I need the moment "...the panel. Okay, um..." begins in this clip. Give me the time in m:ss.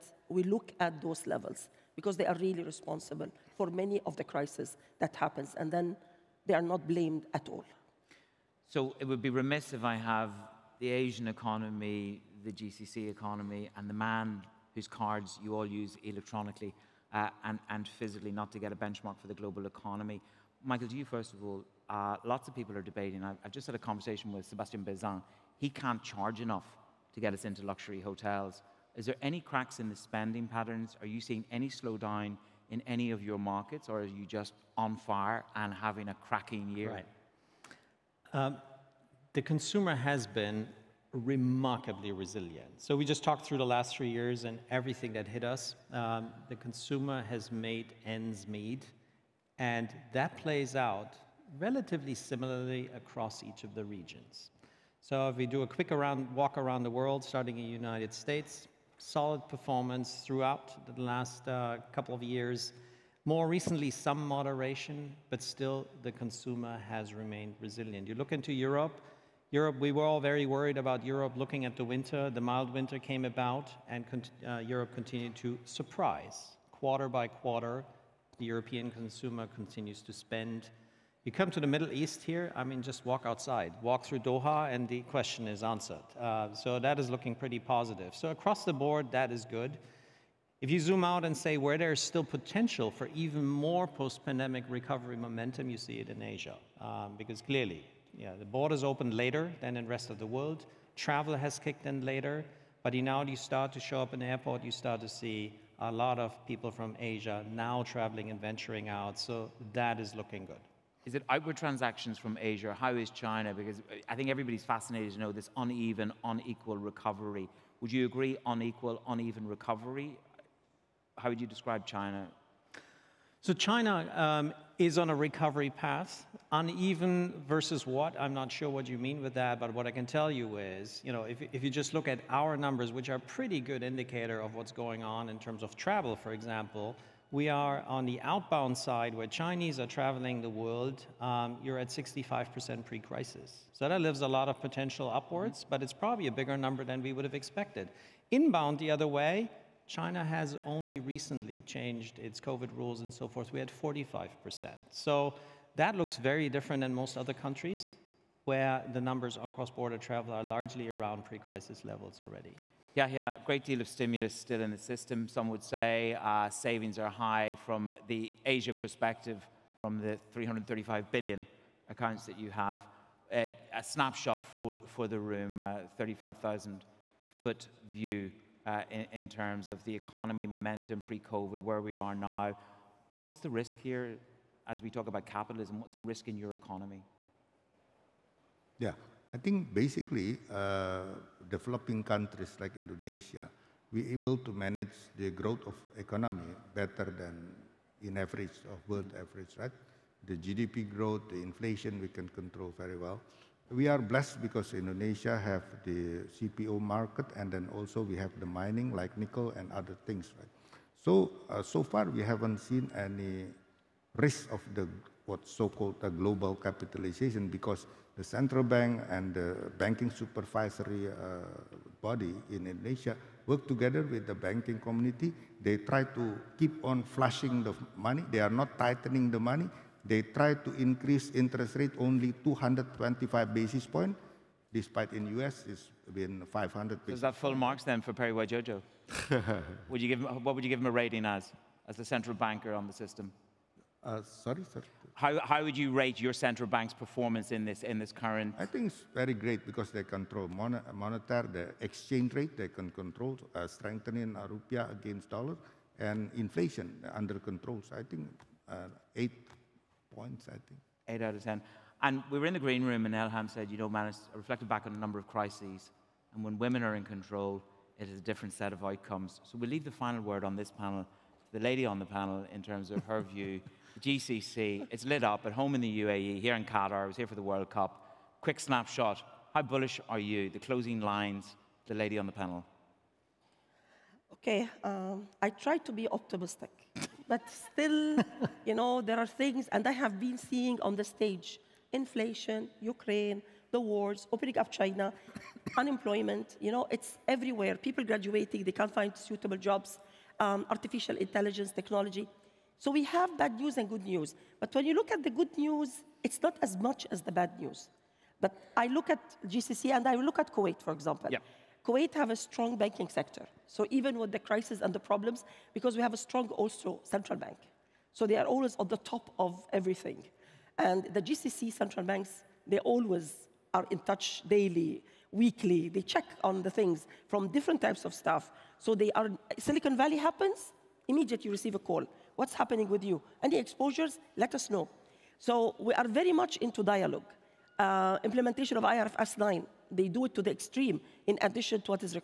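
4:42.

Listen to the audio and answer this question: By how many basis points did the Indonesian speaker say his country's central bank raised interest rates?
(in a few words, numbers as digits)
225.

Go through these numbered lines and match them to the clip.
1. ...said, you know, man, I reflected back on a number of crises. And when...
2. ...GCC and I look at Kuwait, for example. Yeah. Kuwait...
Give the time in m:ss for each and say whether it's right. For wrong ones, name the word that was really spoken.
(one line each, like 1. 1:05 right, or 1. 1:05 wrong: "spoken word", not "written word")
1. 4:23 right
2. 5:09 right.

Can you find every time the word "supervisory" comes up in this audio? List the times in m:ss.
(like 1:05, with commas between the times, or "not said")
3:40.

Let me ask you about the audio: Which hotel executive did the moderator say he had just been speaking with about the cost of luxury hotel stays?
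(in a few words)
Sébastien Bazin.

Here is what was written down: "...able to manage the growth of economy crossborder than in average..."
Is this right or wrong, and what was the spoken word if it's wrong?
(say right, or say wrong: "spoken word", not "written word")
wrong: "better", not "crossborder".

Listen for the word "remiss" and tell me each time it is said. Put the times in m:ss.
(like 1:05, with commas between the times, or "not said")
0:09.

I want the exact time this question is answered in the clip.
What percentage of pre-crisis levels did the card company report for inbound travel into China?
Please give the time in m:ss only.
2:33.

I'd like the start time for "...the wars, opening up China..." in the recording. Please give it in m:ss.
4:53.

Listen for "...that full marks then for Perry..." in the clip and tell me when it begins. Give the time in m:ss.
3:57.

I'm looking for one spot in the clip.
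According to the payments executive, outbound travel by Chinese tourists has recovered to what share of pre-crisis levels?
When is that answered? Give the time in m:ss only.
2:21.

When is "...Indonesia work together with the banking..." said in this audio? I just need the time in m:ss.
3:42.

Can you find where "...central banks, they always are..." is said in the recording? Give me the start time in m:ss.
5:21.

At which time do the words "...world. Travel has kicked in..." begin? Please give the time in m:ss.
1:40.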